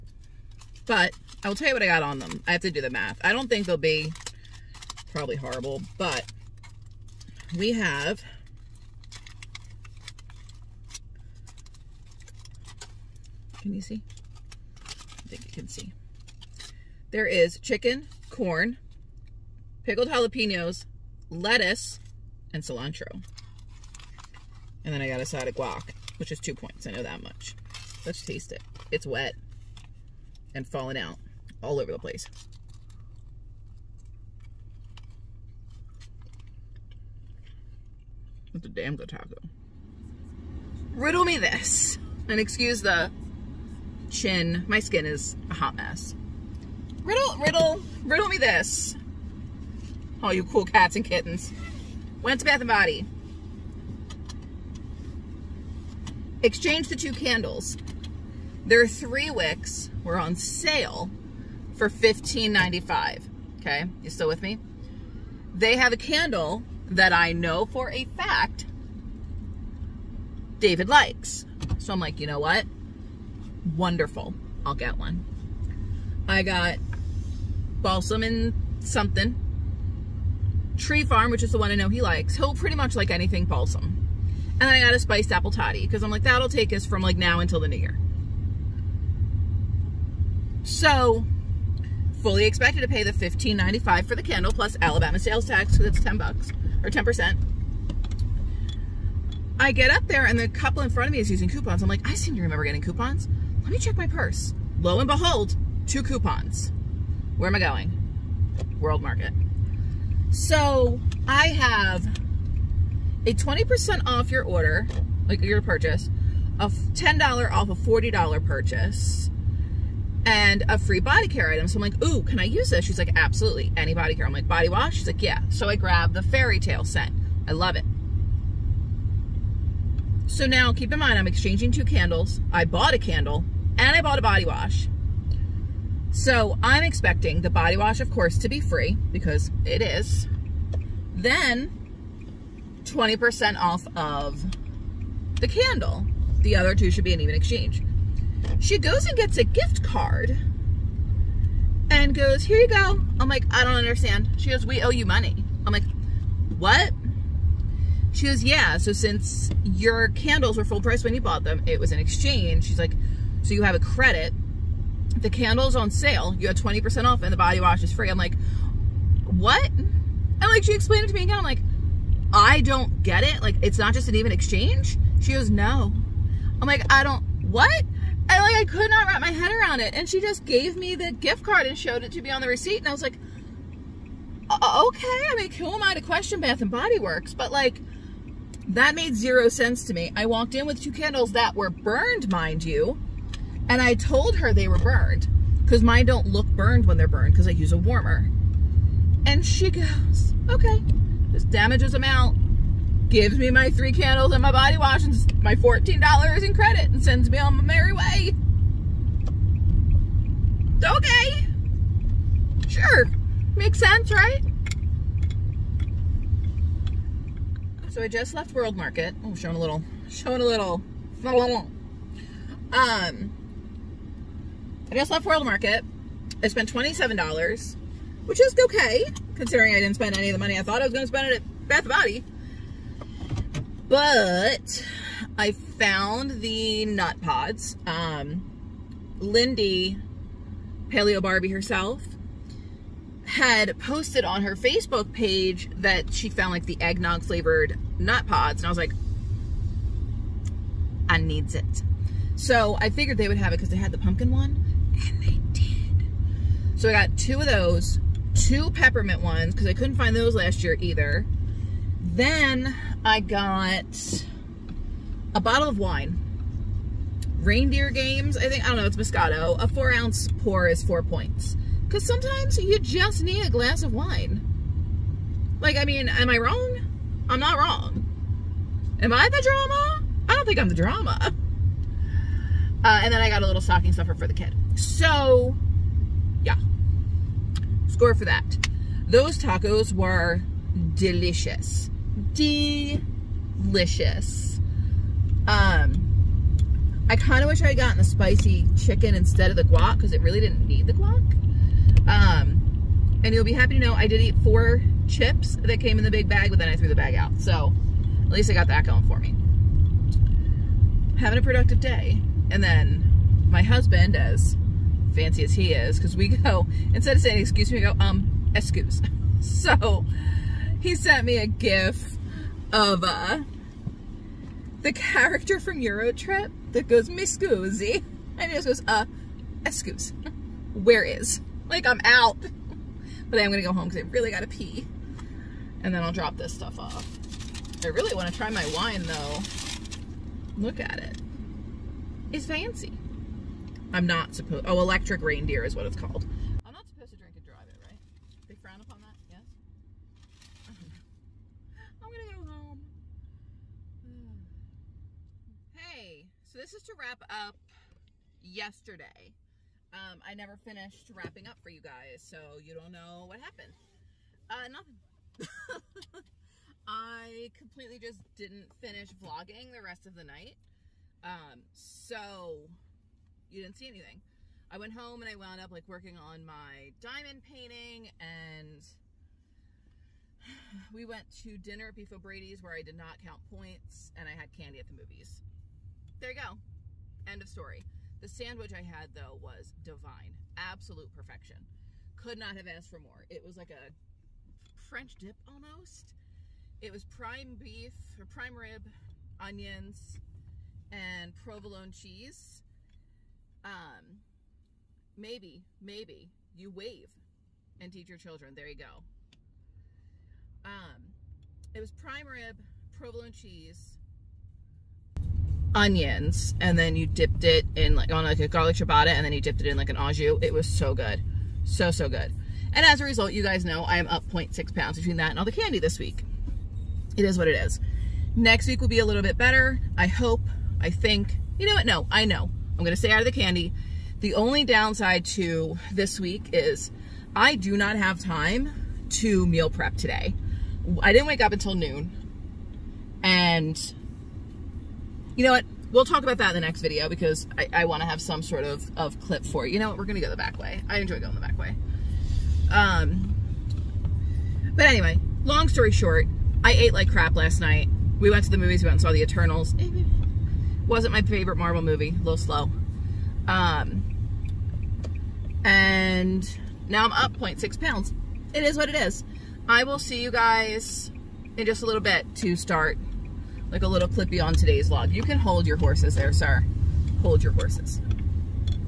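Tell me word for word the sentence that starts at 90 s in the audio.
So, fully expected to pay the $15.95 for the candle plus Alabama sales tax because it's 10 bucks or 10%.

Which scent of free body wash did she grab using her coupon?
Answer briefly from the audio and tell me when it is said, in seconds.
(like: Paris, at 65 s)
fairy tale, at 126 s.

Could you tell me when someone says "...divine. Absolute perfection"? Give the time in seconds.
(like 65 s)
389 s.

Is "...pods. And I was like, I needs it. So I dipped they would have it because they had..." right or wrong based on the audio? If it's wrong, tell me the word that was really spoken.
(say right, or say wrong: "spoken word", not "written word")
wrong: "figured", not "dipped".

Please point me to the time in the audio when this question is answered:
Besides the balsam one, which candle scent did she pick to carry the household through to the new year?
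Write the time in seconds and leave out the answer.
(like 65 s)
84 s.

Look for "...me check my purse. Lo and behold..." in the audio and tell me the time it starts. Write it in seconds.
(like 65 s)
103 s.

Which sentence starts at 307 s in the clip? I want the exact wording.
So at least I got that going for me.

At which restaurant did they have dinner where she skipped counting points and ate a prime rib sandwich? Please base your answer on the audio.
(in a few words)
Beef O'Brady's.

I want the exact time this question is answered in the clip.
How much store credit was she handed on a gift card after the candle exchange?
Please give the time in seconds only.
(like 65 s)
205 s.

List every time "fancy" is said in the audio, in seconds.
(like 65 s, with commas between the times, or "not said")
315 s, 342 s.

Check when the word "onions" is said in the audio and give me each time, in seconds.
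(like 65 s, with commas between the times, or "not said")
399 s, 415 s.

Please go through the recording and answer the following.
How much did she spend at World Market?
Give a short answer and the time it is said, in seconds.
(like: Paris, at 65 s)
$27, at 226 s.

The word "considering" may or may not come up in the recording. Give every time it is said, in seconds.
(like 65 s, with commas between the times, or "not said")
229 s.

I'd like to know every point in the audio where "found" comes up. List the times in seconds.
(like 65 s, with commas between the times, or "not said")
235 s, 246 s.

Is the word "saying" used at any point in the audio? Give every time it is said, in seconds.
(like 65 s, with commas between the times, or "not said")
317 s.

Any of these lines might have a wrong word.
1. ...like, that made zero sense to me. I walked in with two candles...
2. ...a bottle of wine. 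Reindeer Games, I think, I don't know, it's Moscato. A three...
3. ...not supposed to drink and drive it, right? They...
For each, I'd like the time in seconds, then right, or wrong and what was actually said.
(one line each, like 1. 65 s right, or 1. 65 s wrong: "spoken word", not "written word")
1. 187 s right
2. 265 s wrong: "four", not "three"
3. 346 s right.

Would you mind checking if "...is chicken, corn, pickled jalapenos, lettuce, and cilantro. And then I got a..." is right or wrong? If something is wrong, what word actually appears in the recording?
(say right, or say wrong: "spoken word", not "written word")
right.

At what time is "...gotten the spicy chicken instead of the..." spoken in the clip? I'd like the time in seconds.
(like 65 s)
297 s.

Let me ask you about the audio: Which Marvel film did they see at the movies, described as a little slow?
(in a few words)
The Eternals.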